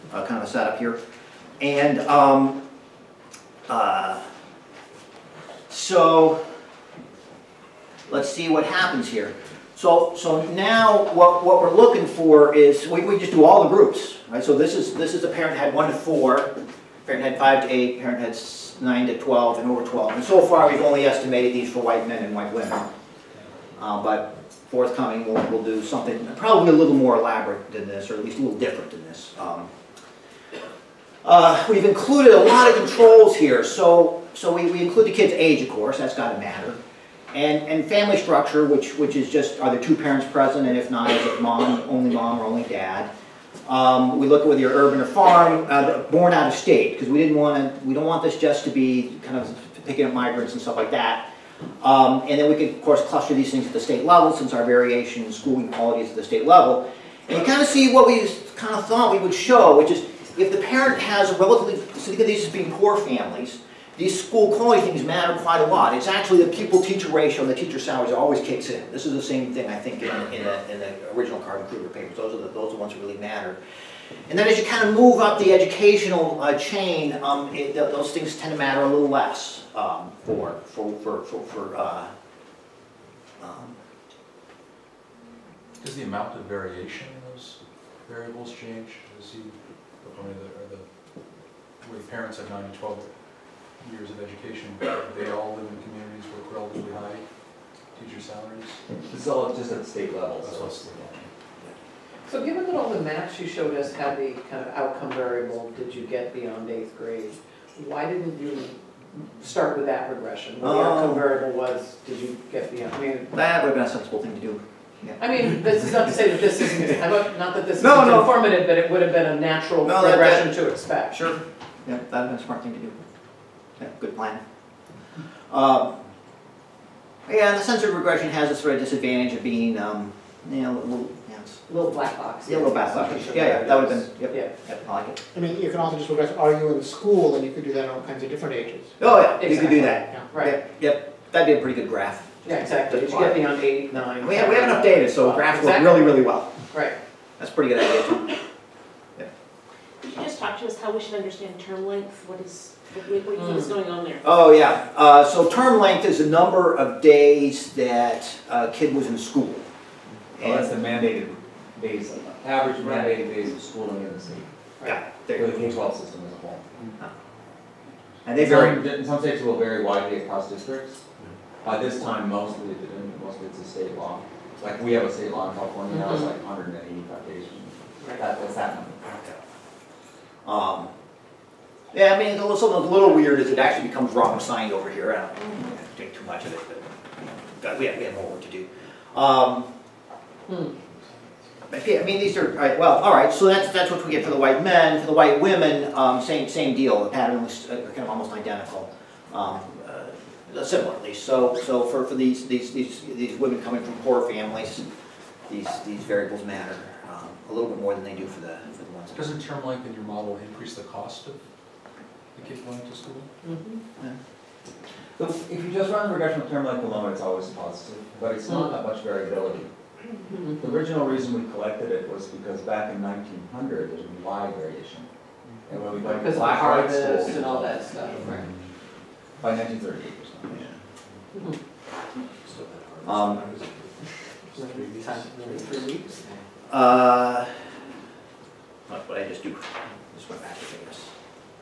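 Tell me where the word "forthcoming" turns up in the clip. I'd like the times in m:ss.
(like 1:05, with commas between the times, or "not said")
0:24.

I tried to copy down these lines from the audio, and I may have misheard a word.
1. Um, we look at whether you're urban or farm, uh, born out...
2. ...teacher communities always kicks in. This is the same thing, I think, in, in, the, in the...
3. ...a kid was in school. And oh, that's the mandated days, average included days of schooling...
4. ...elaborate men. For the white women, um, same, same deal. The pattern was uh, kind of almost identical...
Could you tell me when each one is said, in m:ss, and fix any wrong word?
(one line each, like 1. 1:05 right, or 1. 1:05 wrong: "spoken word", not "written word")
1. 0:43 right
2. 1:07 wrong: "salaries", not "communities"
3. 2:38 wrong: "mandated", not "included"
4. 3:14 wrong: "white", not "elaborate".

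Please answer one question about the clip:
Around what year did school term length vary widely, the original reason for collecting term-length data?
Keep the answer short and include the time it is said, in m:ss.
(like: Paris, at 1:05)
1900, at 3:43.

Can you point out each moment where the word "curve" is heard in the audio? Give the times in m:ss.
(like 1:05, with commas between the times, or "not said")
not said.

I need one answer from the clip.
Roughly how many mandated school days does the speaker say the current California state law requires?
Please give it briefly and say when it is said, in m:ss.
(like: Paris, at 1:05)
185, at 2:56.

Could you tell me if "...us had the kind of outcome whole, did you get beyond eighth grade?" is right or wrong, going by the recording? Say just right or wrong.
wrong.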